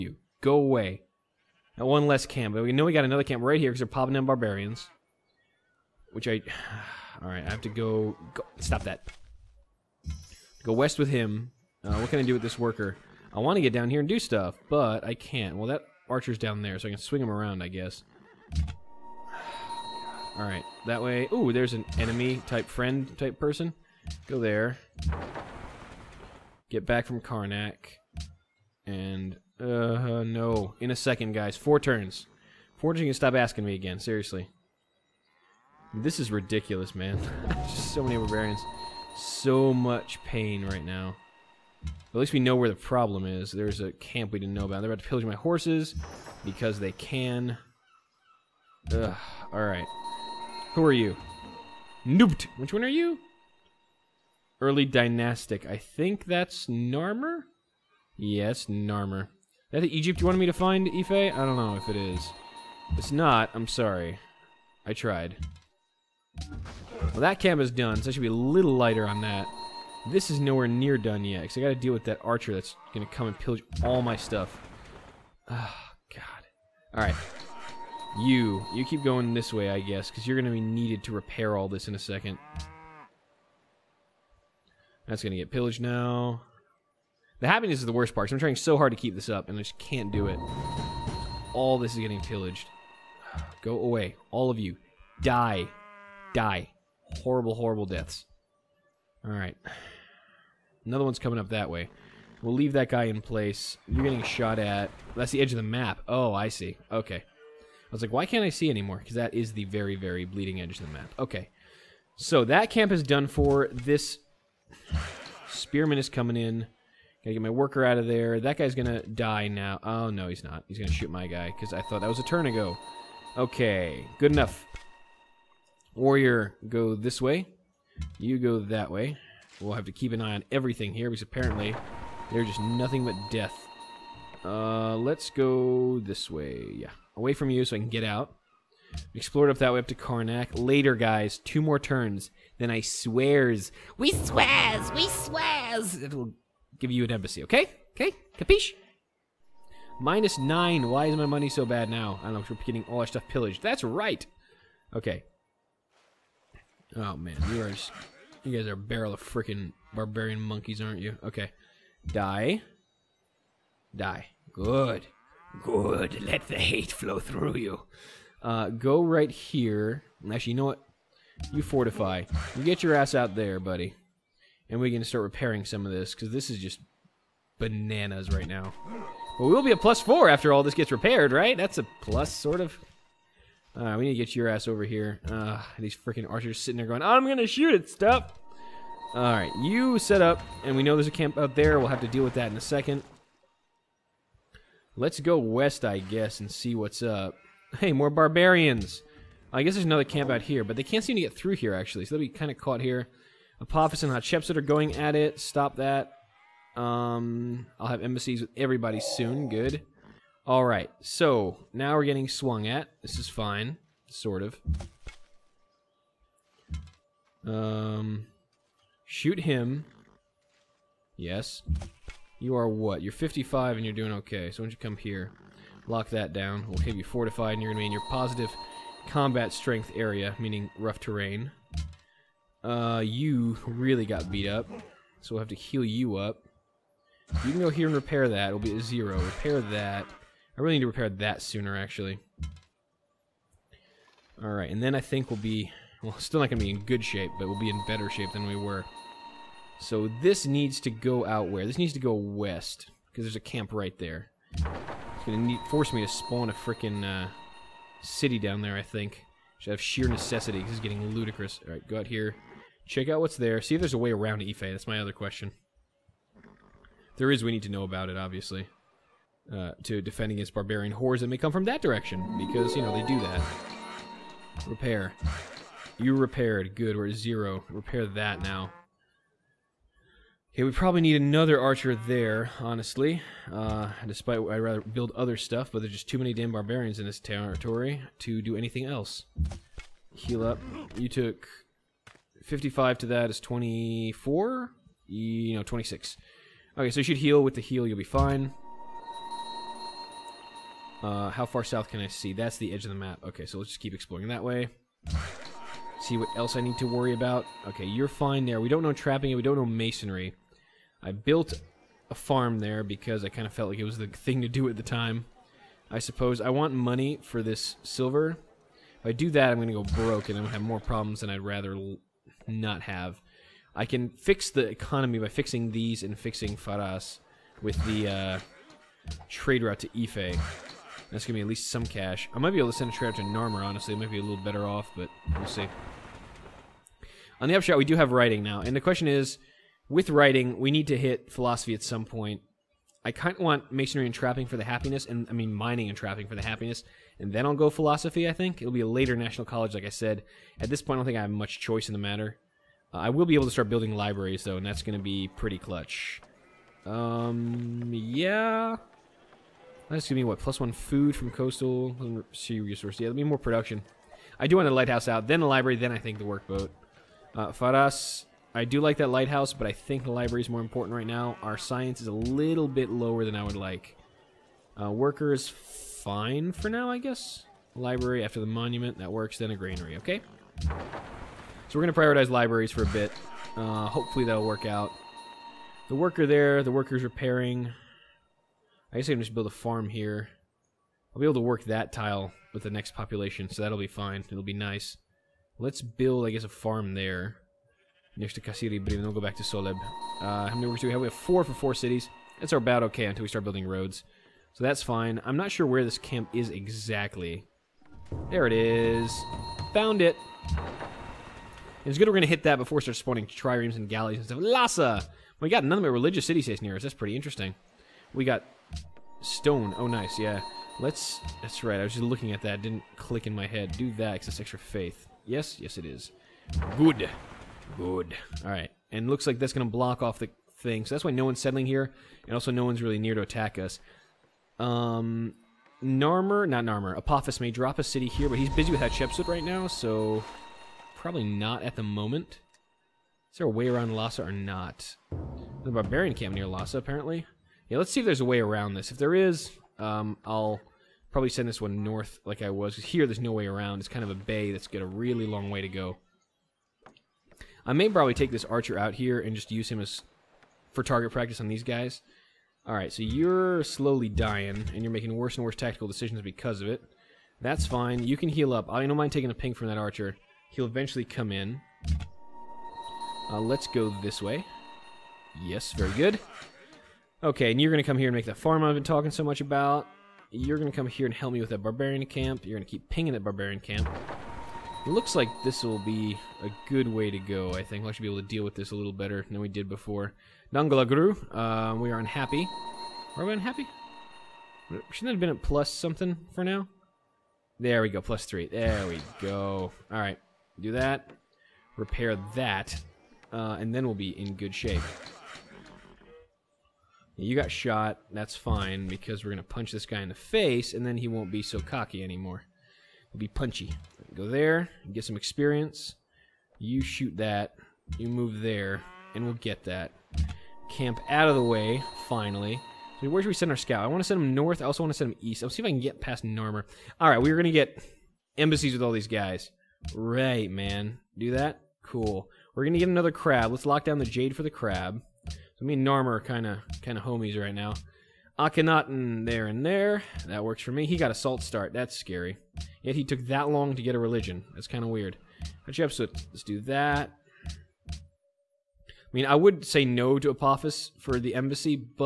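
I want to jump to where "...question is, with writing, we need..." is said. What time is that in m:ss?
5:38.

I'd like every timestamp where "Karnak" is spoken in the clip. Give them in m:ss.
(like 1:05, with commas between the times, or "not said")
0:27, 2:19.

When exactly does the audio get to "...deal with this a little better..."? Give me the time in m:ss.
8:08.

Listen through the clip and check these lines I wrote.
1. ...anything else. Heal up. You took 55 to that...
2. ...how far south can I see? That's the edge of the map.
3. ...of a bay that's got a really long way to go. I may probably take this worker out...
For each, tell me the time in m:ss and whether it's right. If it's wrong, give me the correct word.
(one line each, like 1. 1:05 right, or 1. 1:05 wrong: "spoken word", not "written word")
1. 4:48 right
2. 5:01 right
3. 7:34 wrong: "archer", not "worker".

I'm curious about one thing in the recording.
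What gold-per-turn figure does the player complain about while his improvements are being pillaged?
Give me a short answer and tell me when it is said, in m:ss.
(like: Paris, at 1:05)
-9, at 2:30.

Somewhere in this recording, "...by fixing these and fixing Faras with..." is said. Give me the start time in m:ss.
5:25.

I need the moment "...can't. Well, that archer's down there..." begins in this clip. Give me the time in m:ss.
0:15.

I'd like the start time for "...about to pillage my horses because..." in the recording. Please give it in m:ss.
0:44.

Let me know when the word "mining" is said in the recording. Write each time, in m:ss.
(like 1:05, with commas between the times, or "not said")
5:45.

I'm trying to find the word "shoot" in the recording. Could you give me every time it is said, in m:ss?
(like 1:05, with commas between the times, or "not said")
2:00, 3:07, 3:39, 8:36.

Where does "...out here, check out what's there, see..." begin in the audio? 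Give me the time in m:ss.
4:21.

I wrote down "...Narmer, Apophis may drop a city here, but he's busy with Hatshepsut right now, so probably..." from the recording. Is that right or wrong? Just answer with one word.
right.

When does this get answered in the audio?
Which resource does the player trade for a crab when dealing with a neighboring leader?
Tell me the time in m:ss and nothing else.
8:54.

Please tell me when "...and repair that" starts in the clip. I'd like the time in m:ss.
3:57.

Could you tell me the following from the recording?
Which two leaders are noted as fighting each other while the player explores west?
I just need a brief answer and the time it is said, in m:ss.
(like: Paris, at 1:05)
Apophis and Hatshepsut, at 3:23.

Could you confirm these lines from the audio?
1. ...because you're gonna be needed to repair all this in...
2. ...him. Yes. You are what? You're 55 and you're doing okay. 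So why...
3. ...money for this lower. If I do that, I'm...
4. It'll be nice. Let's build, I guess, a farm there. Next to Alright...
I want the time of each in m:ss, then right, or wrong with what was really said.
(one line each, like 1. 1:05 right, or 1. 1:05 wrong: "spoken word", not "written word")
1. 1:20 right
2. 3:39 right
3. 5:16 wrong: "silver", not "lower"
4. 6:34 wrong: "Kasiri", not "Alright".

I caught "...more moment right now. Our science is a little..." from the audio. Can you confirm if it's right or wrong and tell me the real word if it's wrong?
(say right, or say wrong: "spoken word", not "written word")
wrong: "important", not "moment".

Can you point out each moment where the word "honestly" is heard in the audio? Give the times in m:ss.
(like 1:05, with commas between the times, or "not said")
4:42, 5:33.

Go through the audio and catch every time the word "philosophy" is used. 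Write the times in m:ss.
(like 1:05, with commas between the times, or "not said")
5:41, 5:47.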